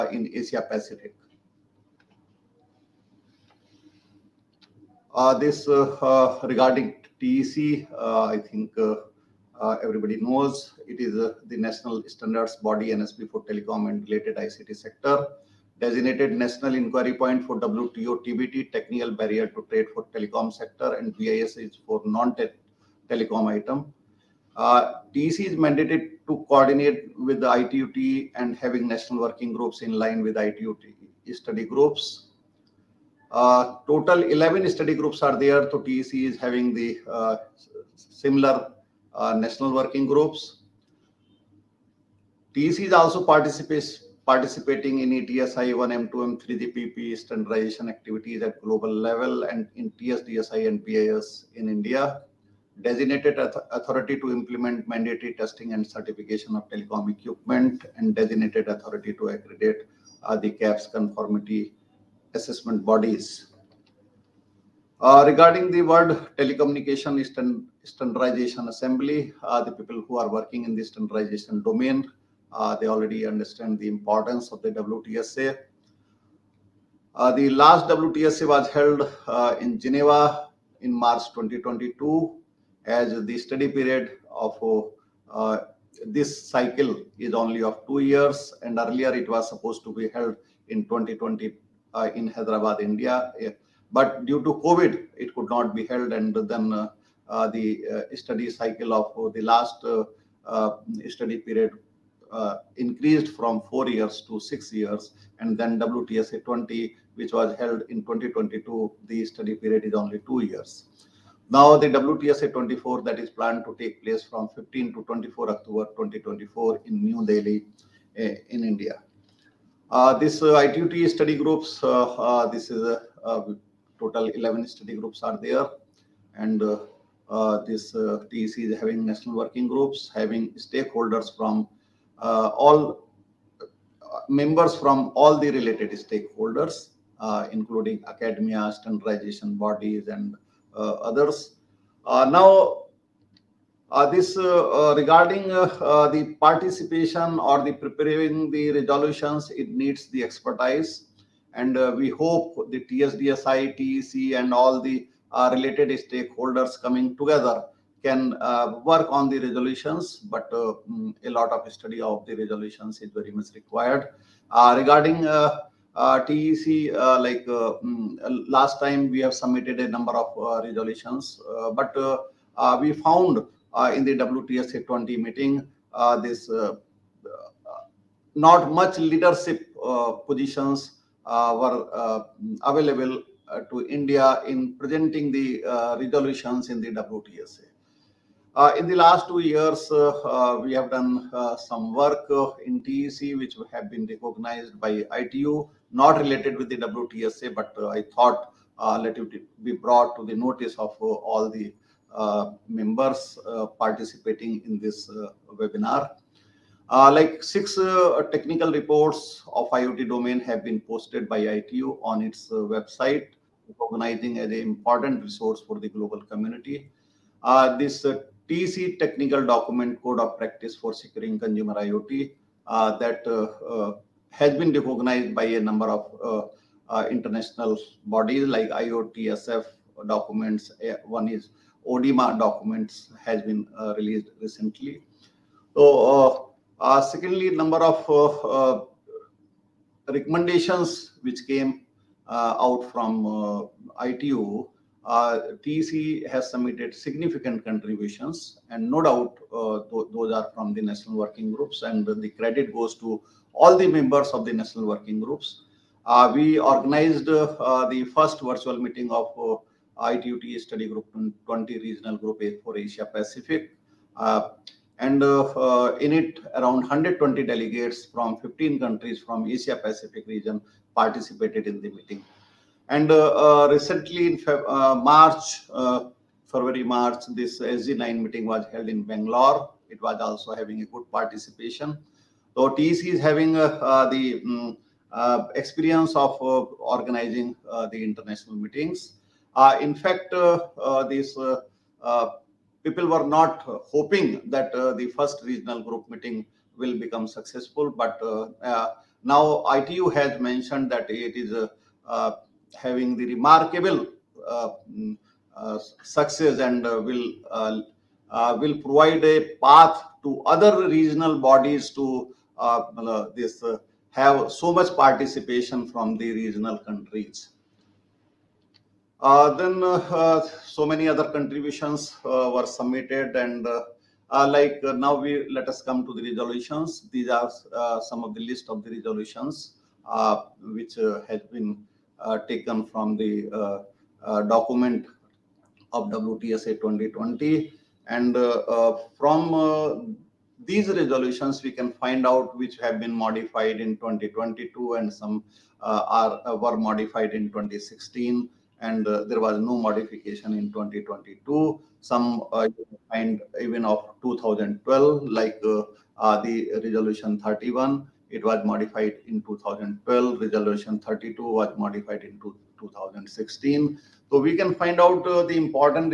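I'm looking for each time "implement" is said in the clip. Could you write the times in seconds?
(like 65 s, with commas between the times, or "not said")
54 s.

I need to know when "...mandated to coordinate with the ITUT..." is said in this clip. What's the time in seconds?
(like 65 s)
25 s.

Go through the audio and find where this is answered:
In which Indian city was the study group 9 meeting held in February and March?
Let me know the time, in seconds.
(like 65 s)
279 s.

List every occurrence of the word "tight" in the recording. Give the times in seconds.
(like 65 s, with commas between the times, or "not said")
not said.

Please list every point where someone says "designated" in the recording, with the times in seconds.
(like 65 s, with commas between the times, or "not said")
15 s, 52 s, 58 s.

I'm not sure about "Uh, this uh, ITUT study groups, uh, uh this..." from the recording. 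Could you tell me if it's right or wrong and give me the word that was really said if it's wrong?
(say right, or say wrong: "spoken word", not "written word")
right.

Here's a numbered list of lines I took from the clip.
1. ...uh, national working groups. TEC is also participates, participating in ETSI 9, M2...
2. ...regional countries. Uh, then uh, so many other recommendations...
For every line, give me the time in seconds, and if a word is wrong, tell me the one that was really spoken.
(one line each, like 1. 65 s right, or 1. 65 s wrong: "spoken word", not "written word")
1. 39 s wrong: "1", not "9"
2. 316 s wrong: "contributions", not "recommendations".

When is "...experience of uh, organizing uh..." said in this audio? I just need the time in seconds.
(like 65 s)
285 s.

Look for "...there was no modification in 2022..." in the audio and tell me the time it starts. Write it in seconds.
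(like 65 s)
349 s.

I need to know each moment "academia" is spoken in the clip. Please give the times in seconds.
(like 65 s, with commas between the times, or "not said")
138 s.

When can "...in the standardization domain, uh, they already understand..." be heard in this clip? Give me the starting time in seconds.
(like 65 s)
70 s.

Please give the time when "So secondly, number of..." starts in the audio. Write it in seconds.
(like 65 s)
235 s.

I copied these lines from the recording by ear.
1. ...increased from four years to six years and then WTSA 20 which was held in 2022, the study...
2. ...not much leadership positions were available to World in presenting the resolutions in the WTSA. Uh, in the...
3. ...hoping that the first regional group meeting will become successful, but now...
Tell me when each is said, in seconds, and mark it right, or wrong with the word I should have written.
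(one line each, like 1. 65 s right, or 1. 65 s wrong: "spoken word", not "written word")
1. 102 s right
2. 178 s wrong: "India", not "World"
3. 293 s right.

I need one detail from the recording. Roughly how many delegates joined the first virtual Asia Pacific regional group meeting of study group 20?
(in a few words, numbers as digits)
120.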